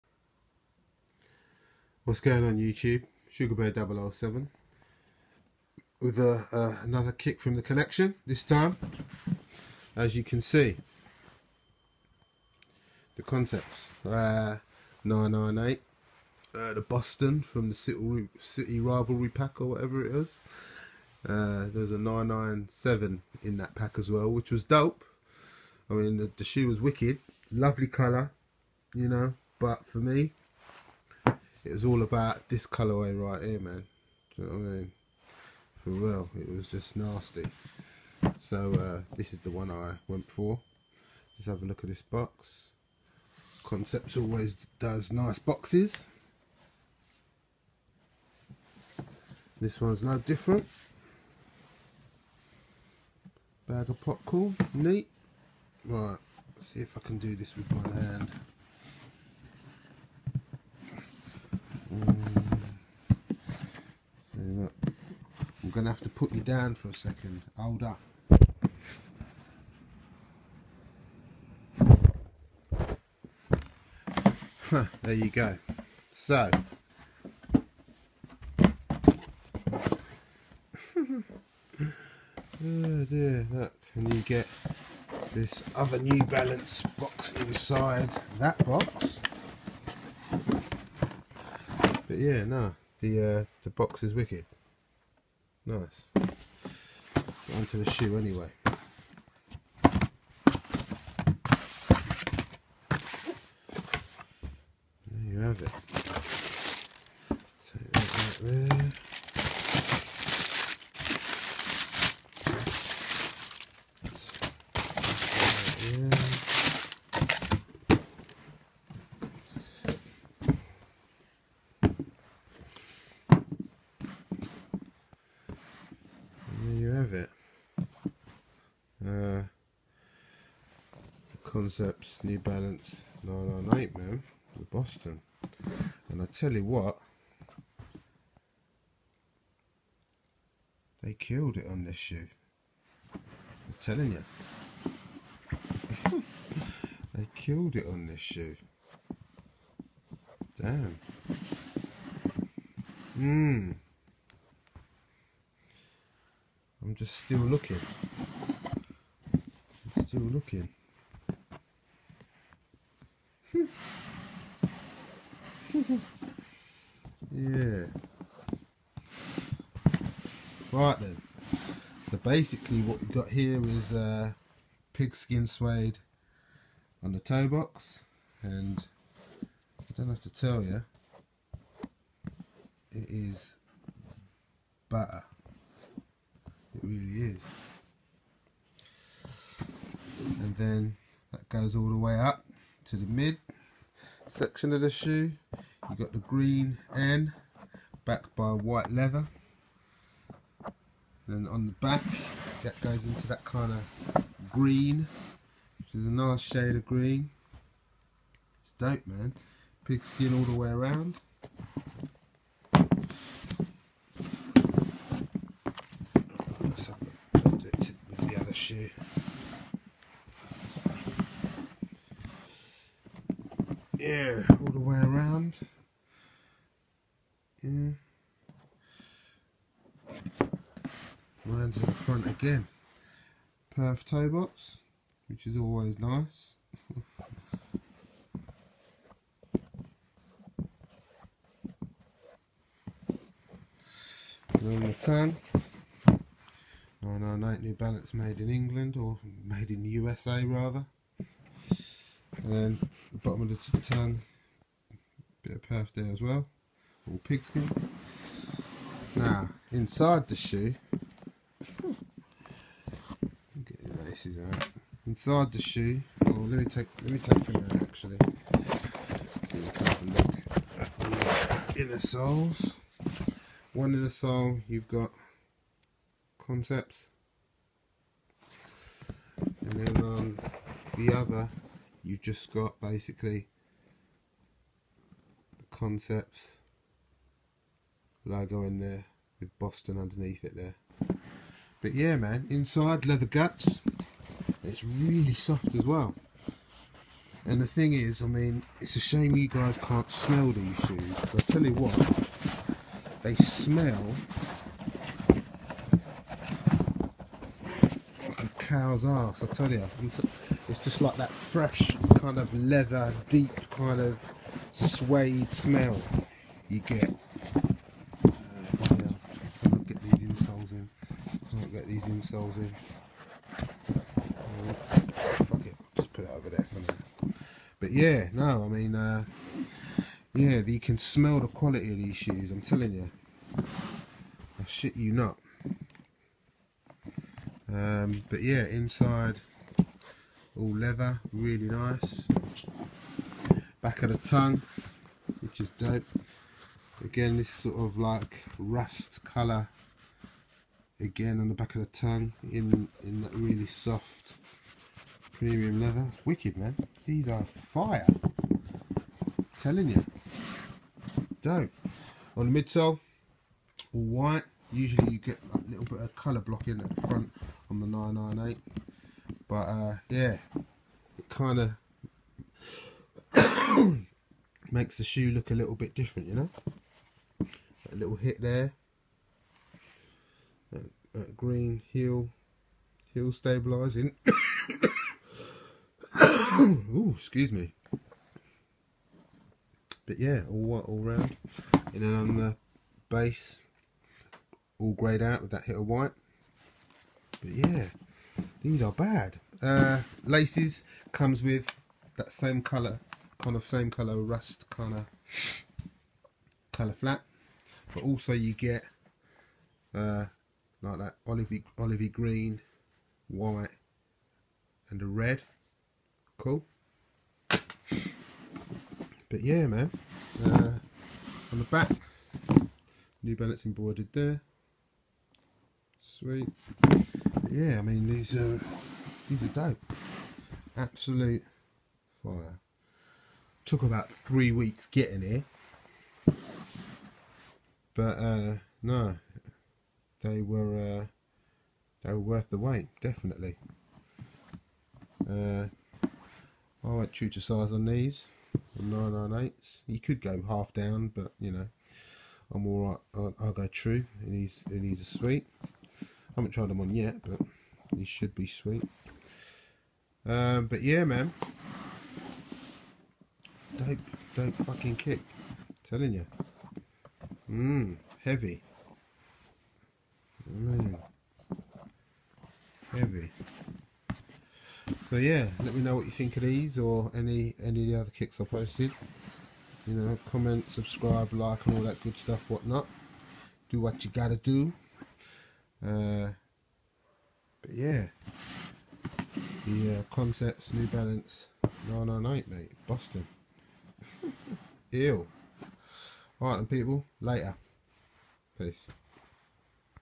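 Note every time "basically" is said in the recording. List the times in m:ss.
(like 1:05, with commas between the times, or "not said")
2:52, 4:42.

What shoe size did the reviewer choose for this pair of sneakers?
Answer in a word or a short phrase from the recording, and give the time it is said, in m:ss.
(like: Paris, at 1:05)
9, at 7:28.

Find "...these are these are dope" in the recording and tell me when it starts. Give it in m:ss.
7:08.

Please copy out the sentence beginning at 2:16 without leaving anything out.
And I tell you what, they killed it on this shoe.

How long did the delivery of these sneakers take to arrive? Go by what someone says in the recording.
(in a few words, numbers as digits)
Three weeks.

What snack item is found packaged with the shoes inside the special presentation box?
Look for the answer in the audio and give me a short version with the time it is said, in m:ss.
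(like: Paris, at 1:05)
Bag of popcorn, at 0:53.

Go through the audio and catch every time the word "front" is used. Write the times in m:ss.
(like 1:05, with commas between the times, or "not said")
3:51, 6:07.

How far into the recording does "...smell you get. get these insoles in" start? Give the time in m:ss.
5:15.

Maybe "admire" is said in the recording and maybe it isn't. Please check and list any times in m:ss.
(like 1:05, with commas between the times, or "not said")
not said.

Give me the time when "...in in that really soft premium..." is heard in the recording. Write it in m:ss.
5:52.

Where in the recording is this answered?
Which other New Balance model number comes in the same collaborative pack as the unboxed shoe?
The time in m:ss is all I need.
0:21.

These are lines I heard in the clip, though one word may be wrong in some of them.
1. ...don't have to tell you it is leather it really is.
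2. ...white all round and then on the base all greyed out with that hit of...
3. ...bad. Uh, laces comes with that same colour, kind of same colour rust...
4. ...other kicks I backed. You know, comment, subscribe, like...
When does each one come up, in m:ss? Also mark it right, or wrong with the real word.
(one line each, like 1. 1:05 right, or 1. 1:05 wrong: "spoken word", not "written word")
1. 2:59 wrong: "butter", not "leather"
2. 6:30 right
3. 6:38 right
4. 7:57 wrong: "posted", not "backed".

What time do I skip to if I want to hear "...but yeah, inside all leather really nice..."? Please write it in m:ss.
5:38.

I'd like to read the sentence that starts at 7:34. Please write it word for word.
It needs, and he's a sweet haven't tried them on yet, but these should be sweet.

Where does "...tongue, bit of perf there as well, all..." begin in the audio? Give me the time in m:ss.
4:13.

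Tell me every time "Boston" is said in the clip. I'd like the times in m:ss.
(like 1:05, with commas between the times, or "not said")
0:16, 2:14, 4:49, 8:12.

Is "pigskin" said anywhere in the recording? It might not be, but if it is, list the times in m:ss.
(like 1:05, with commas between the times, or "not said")
2:54, 3:29, 4:17.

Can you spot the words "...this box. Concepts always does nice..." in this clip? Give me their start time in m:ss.
0:41.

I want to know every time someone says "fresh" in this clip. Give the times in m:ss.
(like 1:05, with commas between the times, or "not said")
5:11.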